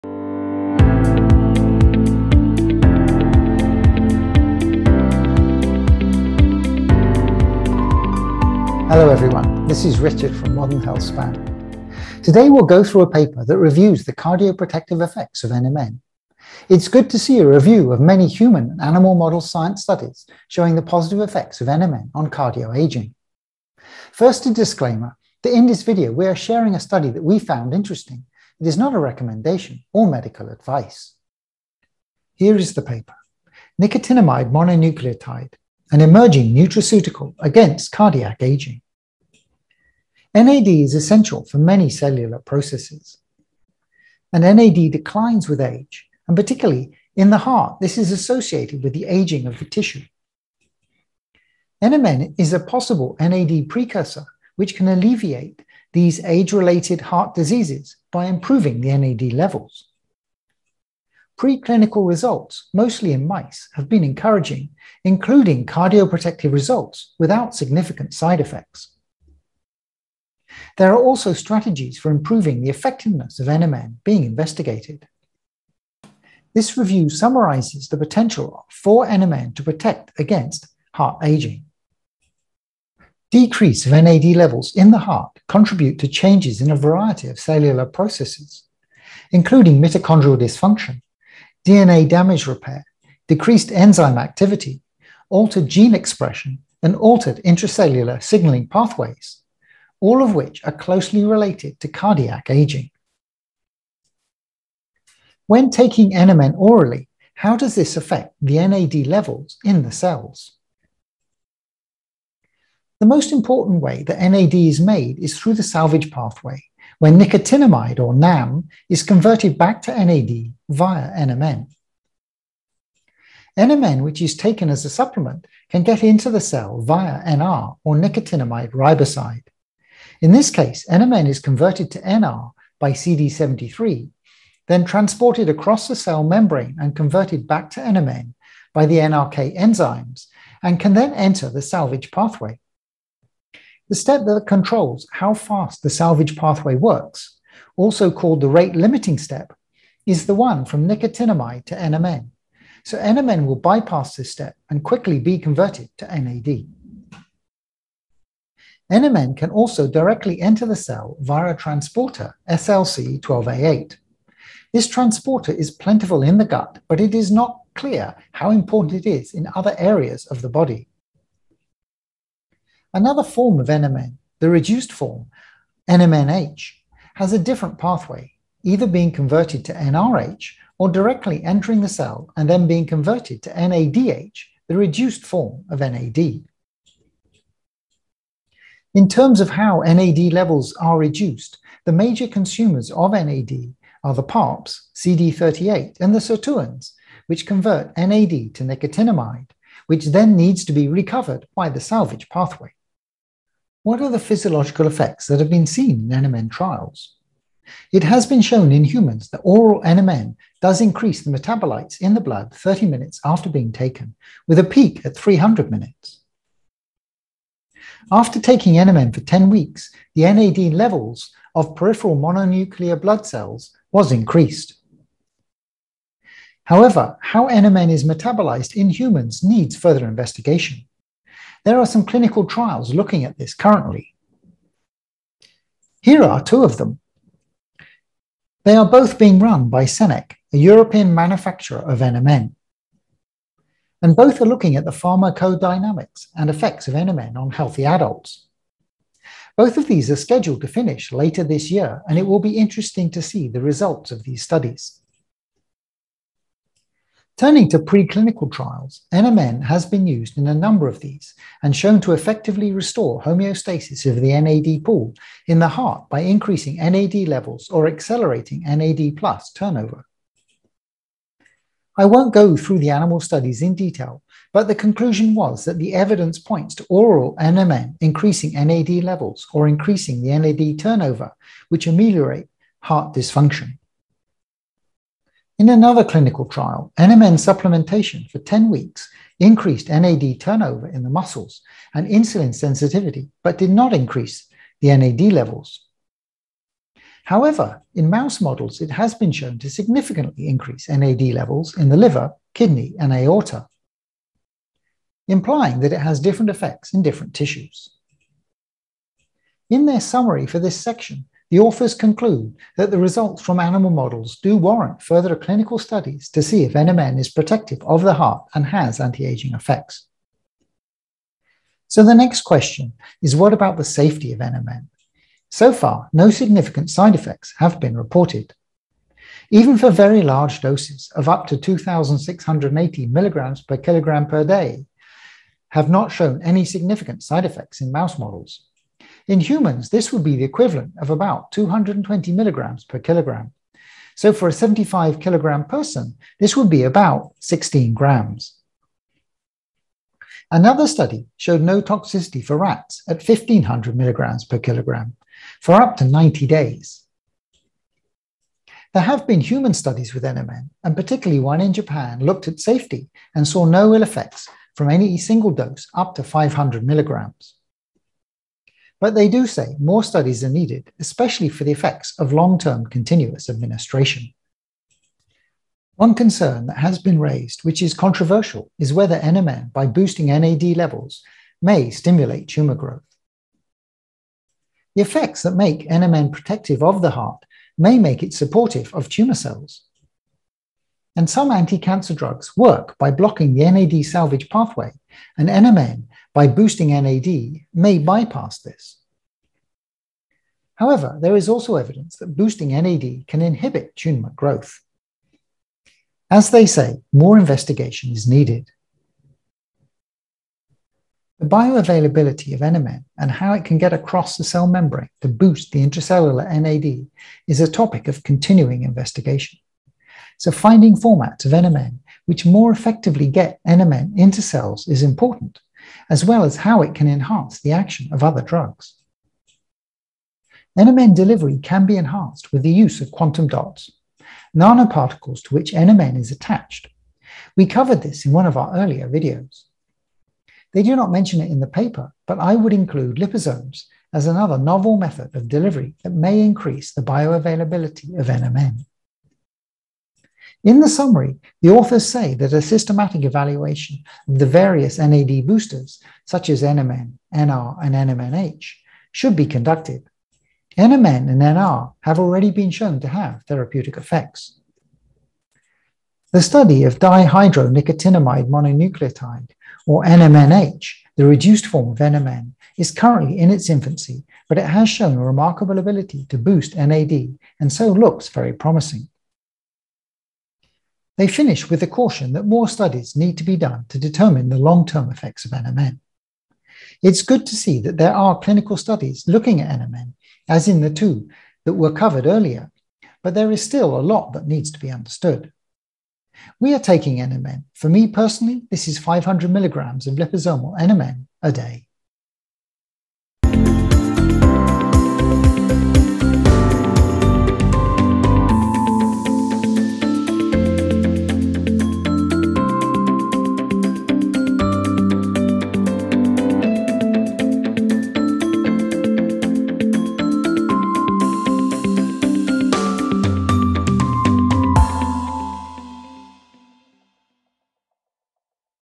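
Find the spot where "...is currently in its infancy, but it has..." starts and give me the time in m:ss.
7:52.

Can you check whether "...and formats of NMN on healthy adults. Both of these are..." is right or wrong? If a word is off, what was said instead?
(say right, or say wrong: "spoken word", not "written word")
wrong: "effects", not "formats".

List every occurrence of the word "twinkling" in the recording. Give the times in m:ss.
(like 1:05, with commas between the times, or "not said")
not said.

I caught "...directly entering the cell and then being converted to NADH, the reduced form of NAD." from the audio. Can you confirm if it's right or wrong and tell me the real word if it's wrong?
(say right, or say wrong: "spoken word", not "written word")
right.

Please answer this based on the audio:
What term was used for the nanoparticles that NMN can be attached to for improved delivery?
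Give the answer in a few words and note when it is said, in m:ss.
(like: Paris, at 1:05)
quantum dots, at 7:13.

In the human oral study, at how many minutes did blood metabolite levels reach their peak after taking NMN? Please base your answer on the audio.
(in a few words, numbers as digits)
300 minutes.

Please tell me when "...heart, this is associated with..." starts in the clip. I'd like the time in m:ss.
0:47.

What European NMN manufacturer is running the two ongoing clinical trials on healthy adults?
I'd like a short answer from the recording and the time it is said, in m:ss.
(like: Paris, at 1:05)
Senec, at 3:59.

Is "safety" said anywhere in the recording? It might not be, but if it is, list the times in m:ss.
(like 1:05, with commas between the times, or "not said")
5:23, 6:02.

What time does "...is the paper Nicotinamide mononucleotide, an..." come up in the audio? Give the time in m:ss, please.
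0:32.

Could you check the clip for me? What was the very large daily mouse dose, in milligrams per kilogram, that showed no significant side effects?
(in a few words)
2,680 mg/kg.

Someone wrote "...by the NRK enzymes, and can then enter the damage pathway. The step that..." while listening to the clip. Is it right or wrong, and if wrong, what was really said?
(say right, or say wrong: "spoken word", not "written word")
wrong: "salvage", not "damage".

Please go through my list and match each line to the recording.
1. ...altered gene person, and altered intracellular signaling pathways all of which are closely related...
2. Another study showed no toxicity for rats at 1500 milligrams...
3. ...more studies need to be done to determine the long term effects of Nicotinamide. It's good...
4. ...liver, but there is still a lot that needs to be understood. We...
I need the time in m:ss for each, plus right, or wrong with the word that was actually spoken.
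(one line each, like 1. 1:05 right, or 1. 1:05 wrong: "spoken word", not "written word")
1. 1:35 wrong: "expression", not "person"
2. 5:50 right
3. 8:02 wrong: "NMN", not "Nicotinamide"
4. 8:12 wrong: "earlier", not "liver".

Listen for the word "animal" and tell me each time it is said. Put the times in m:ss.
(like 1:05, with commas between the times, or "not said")
0:18, 4:32, 5:13.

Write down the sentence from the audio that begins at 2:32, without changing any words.
So NMN will bypass this step and quickly be converted to NAD.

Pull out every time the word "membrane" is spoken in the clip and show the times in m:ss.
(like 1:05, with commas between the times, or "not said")
2:16, 6:54.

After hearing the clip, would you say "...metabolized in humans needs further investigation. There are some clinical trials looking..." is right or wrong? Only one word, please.
right.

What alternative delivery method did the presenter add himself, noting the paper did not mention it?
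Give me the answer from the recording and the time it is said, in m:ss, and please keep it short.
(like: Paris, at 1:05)
liposomes, at 7:23.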